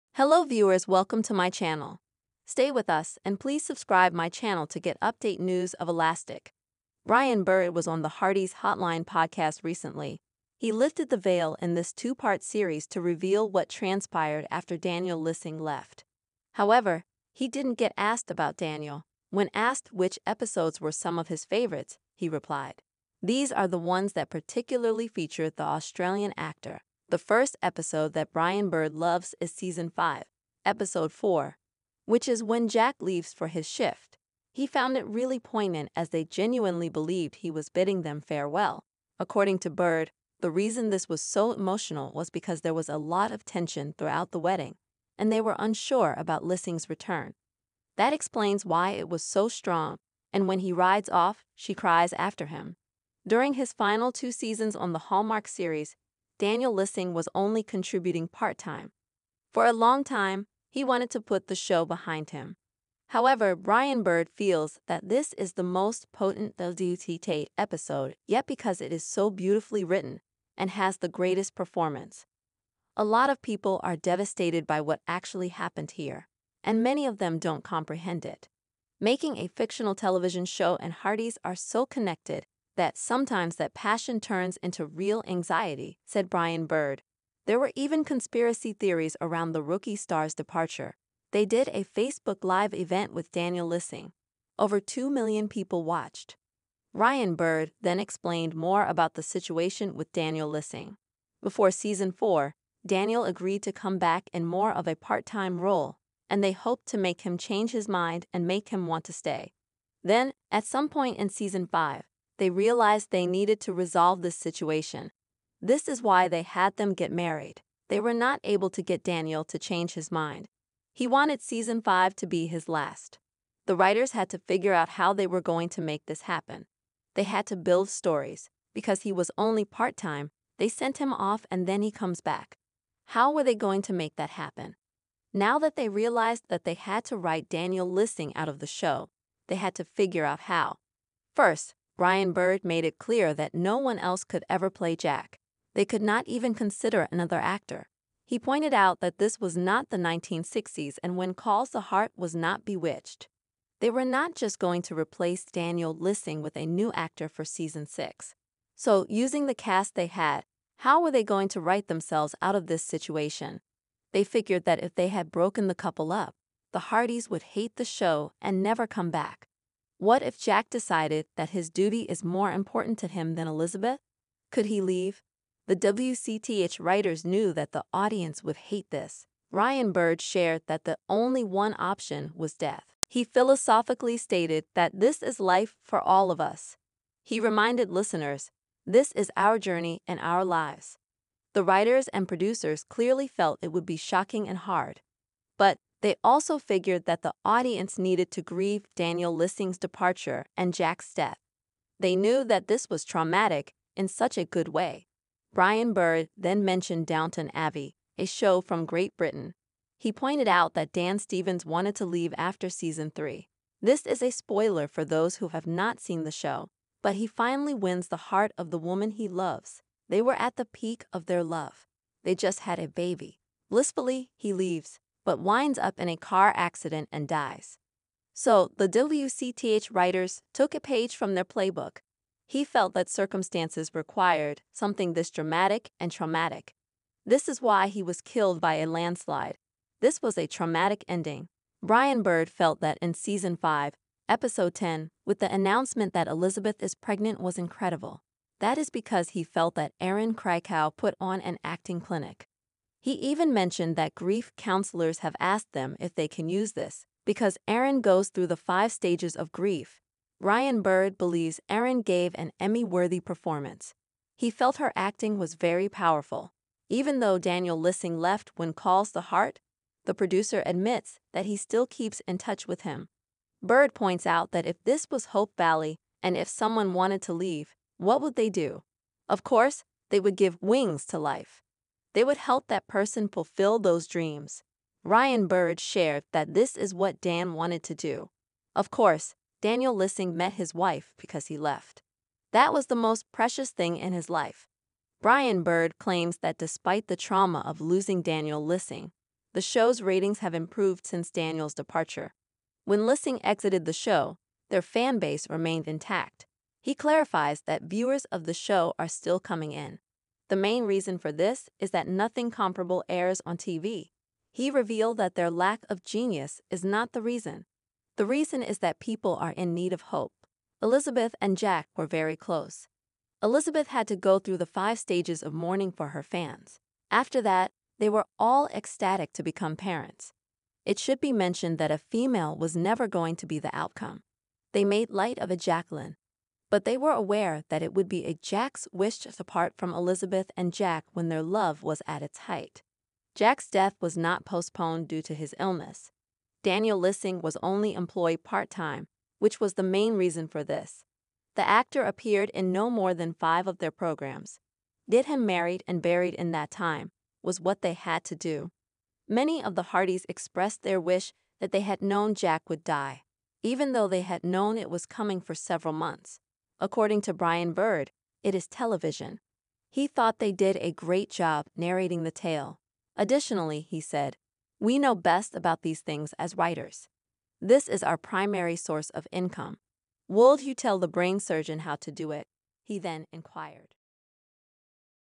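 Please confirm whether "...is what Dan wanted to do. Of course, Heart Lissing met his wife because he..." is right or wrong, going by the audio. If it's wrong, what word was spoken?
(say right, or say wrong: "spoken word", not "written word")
wrong: "Daniel", not "Heart".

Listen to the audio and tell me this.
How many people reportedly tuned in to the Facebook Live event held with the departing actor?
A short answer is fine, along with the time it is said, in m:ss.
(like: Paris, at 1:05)
Over 2 million, at 1:34.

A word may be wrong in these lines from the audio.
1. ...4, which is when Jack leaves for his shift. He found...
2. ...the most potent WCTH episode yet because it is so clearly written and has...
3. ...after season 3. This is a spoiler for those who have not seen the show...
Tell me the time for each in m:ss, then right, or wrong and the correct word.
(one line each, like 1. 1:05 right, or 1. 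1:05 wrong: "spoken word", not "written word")
1. 0:31 right
2. 1:05 wrong: "beautifully", not "clearly"
3. 3:32 right.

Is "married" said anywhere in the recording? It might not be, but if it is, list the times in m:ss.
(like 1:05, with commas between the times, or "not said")
1:57, 5:55.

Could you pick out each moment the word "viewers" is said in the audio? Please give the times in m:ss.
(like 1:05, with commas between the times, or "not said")
0:00, 5:07.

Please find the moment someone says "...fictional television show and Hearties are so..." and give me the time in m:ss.
1:19.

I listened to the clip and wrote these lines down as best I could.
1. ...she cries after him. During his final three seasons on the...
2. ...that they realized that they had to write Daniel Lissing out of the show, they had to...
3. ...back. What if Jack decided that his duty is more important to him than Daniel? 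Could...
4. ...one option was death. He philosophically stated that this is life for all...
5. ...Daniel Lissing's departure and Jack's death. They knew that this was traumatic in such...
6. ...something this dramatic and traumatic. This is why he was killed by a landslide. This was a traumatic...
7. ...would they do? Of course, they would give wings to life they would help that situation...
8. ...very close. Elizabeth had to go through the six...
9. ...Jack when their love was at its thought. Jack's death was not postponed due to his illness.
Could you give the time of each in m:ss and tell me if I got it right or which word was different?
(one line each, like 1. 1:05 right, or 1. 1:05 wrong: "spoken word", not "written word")
1. 0:51 wrong: "two", not "three"
2. 2:15 right
3. 2:49 wrong: "Elizabeth", not "Daniel"
4. 3:01 right
5. 3:18 right
6. 3:54 right
7. 4:38 wrong: "person", not "situation"
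8. 5:22 wrong: "five", not "six"
9. 5:40 wrong: "height", not "thought".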